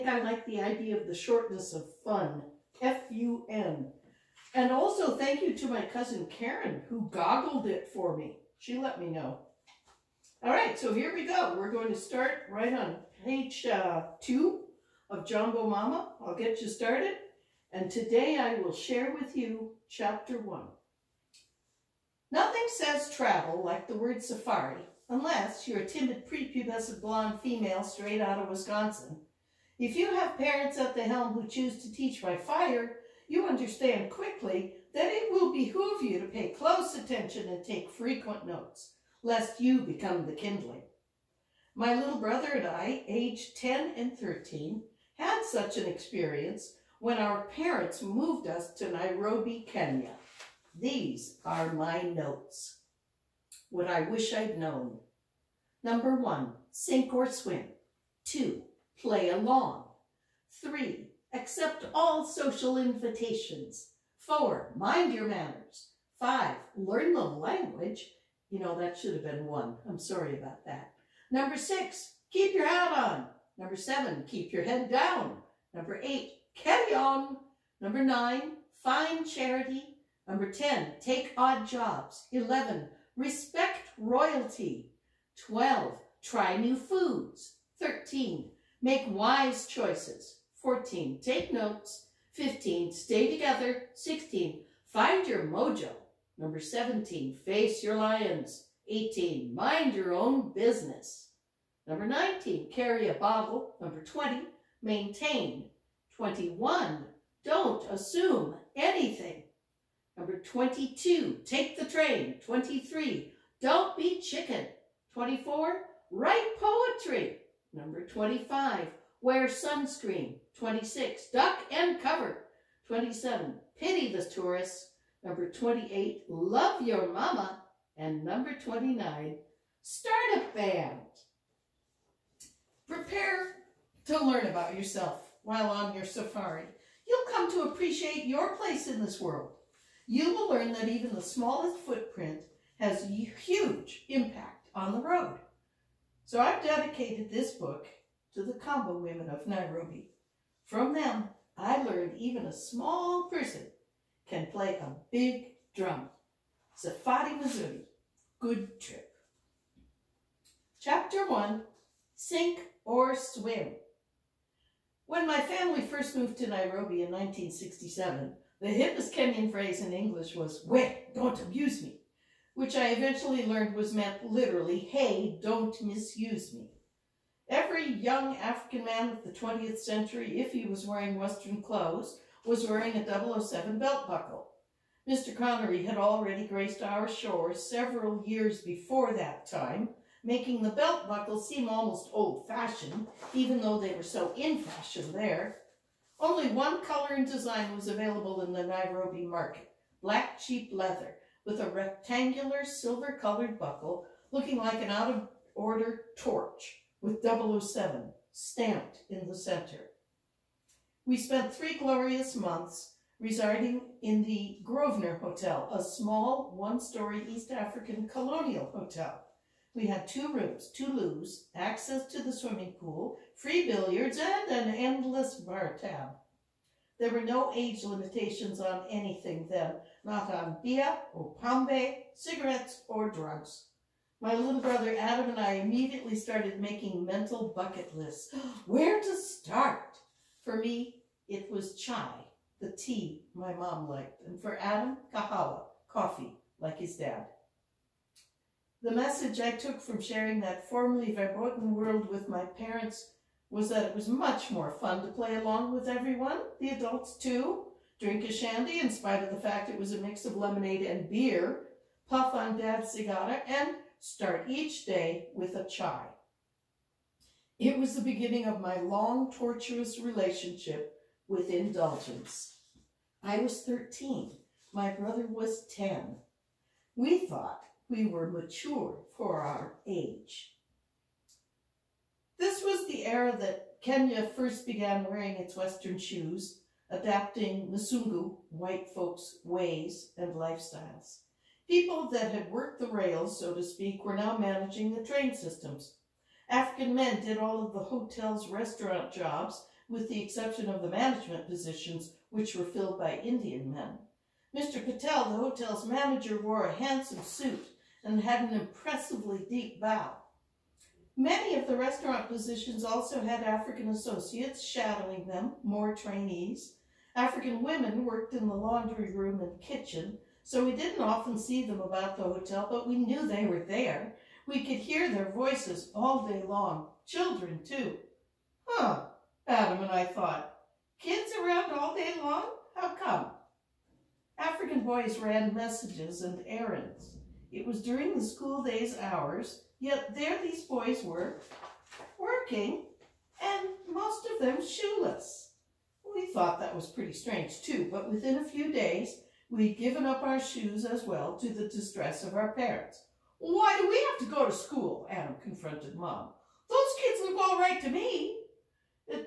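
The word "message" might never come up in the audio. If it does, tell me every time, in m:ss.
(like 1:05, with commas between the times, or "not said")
4:08, 5:35.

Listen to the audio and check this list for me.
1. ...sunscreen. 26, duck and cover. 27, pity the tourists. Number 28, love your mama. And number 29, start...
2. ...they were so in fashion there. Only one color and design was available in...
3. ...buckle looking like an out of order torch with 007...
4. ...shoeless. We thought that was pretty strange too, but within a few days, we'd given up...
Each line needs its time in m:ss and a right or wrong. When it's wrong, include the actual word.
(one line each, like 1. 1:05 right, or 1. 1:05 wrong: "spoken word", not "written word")
1. 1:59 right
2. 3:13 right
3. 3:23 right
4. 5:44 right.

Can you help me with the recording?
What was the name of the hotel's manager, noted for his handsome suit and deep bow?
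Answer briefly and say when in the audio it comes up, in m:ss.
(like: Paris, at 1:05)
Mr. Patel, at 5:04.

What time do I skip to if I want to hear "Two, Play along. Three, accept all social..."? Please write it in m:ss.
0:58.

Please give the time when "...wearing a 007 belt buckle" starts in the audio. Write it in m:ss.
3:02.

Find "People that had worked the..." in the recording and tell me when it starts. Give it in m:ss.
4:51.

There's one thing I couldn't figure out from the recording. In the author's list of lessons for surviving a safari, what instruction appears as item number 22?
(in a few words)
Take the train.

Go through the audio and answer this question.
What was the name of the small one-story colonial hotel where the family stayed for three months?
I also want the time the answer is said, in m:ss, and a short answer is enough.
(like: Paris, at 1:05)
Grosvenor Hotel, at 3:34.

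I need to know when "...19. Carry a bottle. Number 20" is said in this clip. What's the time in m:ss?
1:42.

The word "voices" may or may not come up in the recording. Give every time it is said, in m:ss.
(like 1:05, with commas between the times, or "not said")
5:25.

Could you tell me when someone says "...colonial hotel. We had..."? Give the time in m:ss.
3:38.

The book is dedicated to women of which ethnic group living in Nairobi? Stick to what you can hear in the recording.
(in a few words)
Kamba.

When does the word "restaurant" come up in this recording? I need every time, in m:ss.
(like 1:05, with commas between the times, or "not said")
4:58, 5:11.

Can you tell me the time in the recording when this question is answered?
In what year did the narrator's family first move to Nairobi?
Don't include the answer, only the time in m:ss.
2:47.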